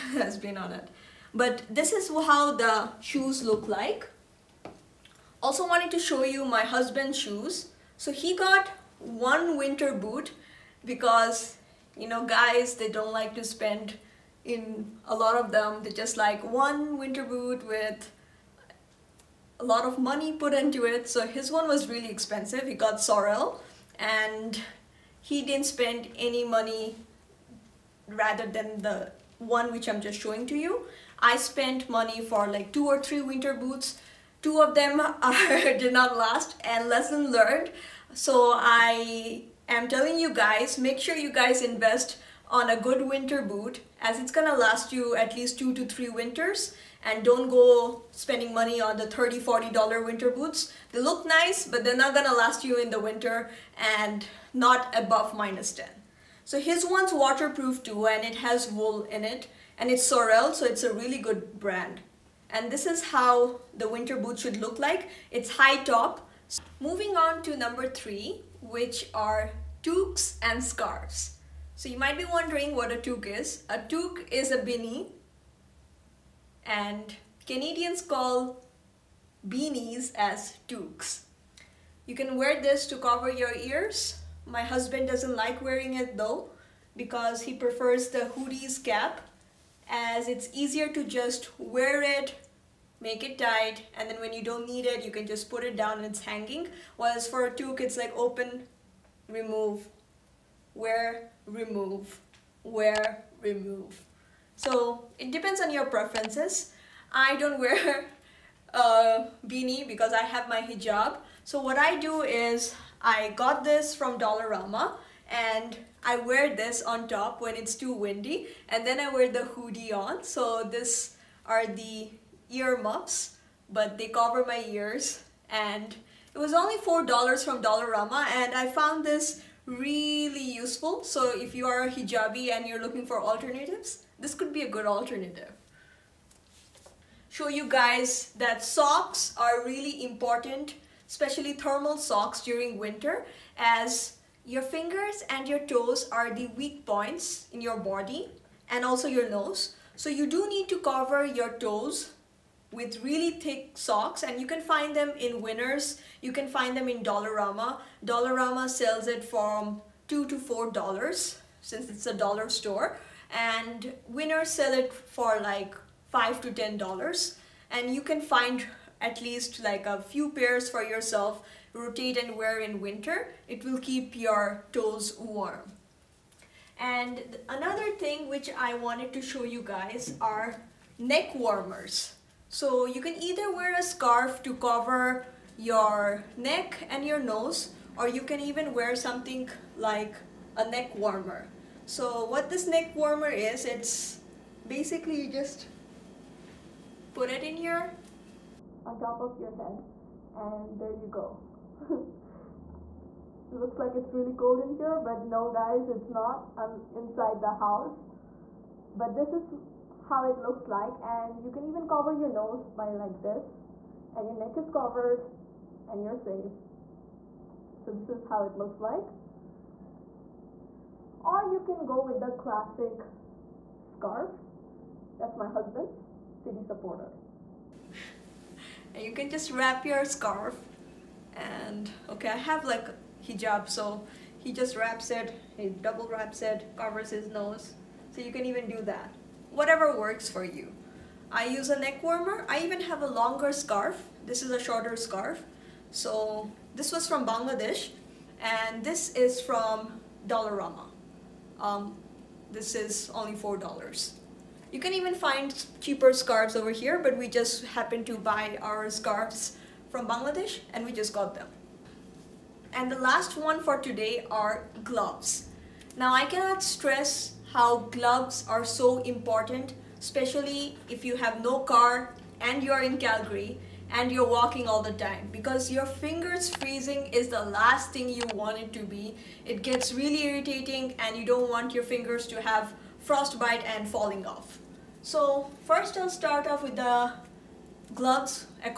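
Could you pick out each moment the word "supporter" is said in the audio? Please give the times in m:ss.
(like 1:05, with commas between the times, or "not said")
3:46.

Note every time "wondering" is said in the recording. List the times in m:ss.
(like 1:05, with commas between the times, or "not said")
1:12.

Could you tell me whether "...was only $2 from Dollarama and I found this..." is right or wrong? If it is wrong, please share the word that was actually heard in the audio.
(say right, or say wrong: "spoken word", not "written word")
wrong: "4", not "2".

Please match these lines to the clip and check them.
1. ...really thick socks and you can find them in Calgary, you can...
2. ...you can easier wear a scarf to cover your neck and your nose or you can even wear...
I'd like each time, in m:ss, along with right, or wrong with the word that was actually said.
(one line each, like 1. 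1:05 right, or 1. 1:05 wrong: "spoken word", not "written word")
1. 2:33 wrong: "Winners", not "Calgary"
2. 3:02 wrong: "either", not "easier".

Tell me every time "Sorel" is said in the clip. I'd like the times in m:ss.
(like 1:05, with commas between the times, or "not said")
0:23, 1:00.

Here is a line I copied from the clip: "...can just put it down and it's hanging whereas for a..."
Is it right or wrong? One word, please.
right.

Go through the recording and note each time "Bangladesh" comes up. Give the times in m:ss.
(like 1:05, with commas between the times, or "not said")
4:07, 4:20.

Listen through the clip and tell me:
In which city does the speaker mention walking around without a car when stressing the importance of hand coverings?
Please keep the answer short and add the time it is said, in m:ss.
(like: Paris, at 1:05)
Calgary, at 4:32.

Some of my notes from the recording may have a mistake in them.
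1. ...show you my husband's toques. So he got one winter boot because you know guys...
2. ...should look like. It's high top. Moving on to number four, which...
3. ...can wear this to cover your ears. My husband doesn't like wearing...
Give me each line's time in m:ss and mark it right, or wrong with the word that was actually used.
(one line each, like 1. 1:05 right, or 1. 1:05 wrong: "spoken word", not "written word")
1. 0:05 wrong: "shoes", not "toques"
2. 1:04 wrong: "three", not "four"
3. 1:22 right.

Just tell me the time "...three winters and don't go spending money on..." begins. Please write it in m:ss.
0:45.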